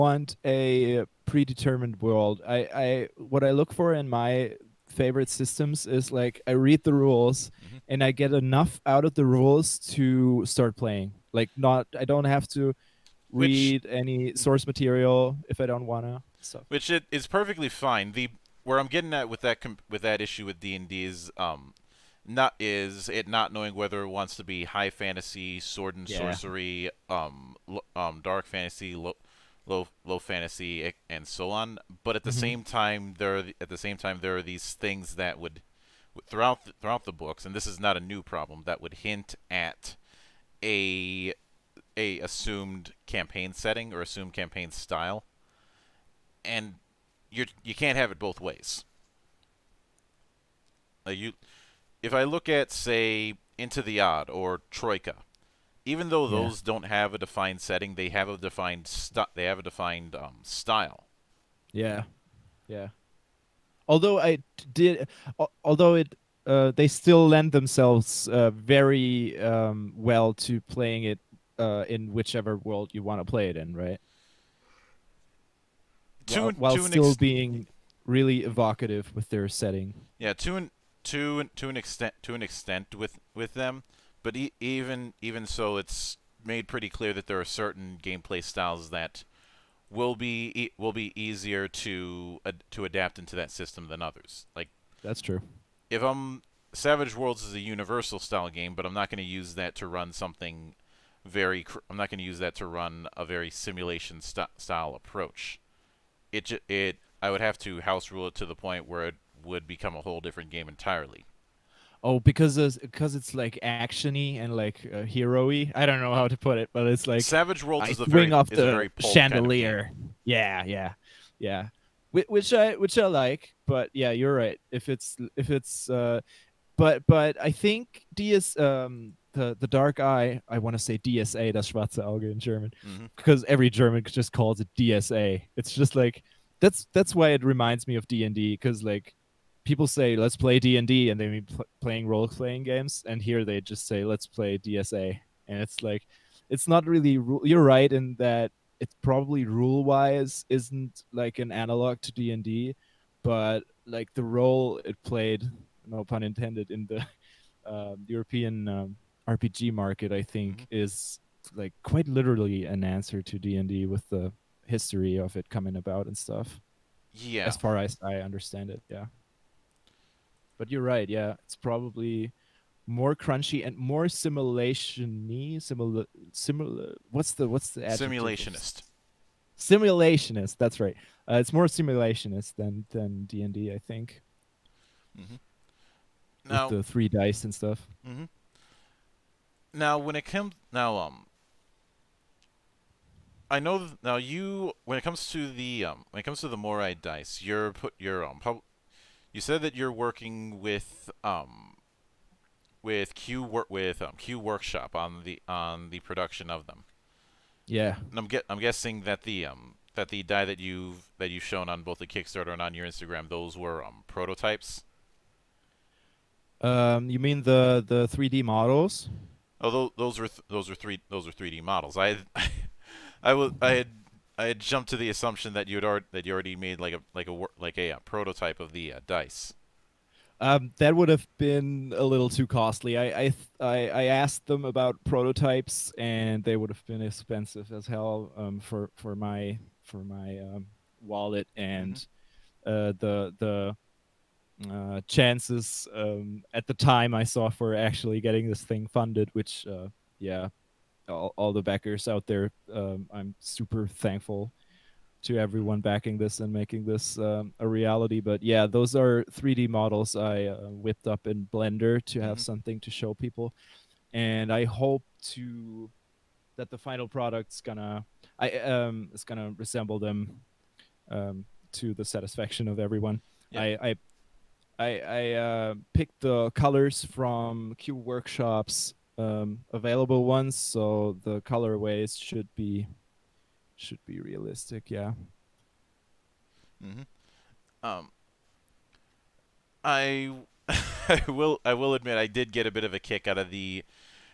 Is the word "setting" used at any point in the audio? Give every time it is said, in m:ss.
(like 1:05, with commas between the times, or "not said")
0:43, 0:57, 1:19.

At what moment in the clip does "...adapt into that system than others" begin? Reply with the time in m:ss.
1:32.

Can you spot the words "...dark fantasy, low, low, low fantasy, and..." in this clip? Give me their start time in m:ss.
0:28.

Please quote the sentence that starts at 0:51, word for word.
Uh, you, if I look at say Into the Odd or Troika, even though yeah.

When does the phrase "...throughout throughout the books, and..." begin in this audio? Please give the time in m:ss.
0:36.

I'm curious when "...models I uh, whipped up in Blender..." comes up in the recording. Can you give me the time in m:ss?
4:19.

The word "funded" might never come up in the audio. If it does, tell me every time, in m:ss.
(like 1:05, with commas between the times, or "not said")
4:08.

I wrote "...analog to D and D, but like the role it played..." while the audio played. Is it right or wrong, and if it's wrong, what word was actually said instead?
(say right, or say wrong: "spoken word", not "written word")
right.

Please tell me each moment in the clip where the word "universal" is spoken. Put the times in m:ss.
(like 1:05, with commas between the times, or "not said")
1:37.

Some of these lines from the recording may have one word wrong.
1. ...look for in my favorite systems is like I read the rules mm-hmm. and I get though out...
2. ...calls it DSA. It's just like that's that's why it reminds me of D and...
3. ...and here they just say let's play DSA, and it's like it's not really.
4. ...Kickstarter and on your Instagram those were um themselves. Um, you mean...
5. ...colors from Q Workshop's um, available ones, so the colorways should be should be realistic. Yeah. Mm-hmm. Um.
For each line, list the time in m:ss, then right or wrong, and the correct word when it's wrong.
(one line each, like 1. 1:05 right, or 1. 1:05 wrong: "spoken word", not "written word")
1. 0:03 wrong: "enough", not "though"
2. 2:14 right
3. 2:23 right
4. 3:32 wrong: "prototypes", not "themselves"
5. 4:36 right.